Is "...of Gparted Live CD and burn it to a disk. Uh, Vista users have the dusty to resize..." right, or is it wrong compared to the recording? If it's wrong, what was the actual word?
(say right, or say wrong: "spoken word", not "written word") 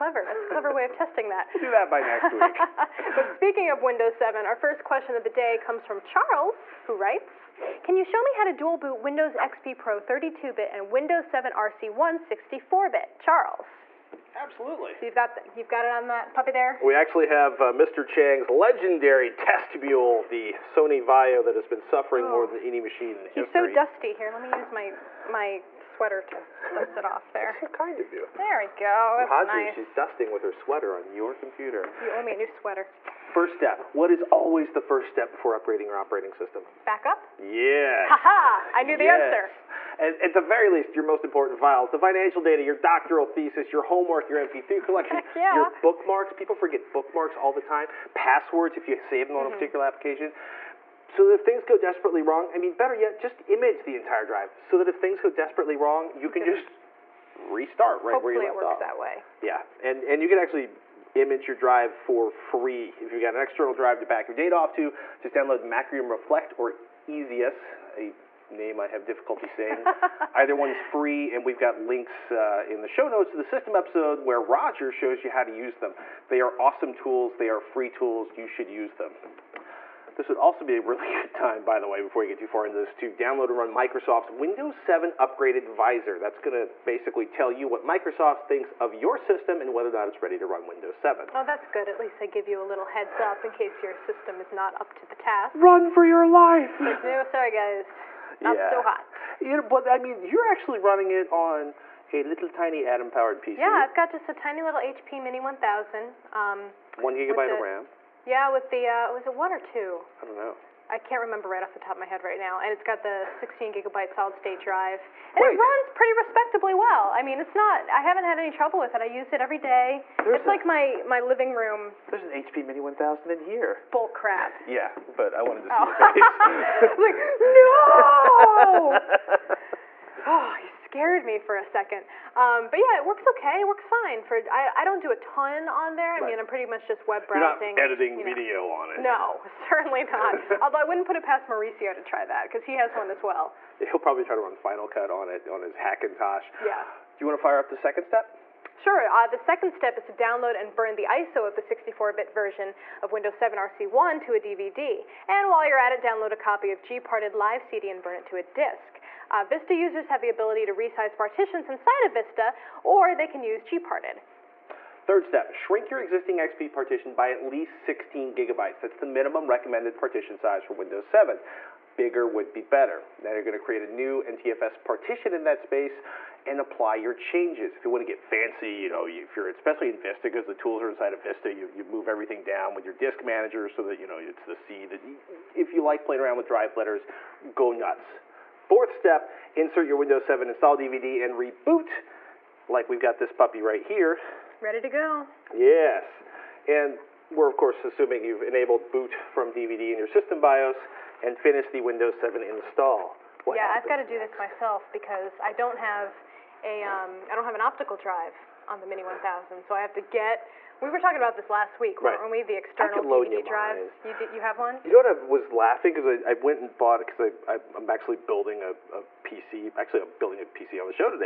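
wrong: "ability", not "dusty".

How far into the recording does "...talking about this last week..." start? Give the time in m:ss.
3:30.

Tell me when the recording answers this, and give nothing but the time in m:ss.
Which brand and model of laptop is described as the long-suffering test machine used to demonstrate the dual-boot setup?
0:20.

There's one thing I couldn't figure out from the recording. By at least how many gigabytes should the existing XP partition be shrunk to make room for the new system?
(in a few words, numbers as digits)
16.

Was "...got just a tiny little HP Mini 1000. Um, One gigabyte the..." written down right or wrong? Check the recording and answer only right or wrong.
right.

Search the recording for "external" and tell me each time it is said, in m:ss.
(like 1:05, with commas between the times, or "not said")
1:03, 3:32.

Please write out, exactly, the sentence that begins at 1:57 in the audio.
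I haven't had any trouble with it.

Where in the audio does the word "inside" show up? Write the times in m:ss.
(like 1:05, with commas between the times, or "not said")
2:41, 3:00.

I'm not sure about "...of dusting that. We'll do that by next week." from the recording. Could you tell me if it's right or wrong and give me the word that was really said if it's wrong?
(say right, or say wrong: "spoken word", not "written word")
wrong: "testing", not "dusting".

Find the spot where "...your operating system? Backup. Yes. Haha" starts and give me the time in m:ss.
0:35.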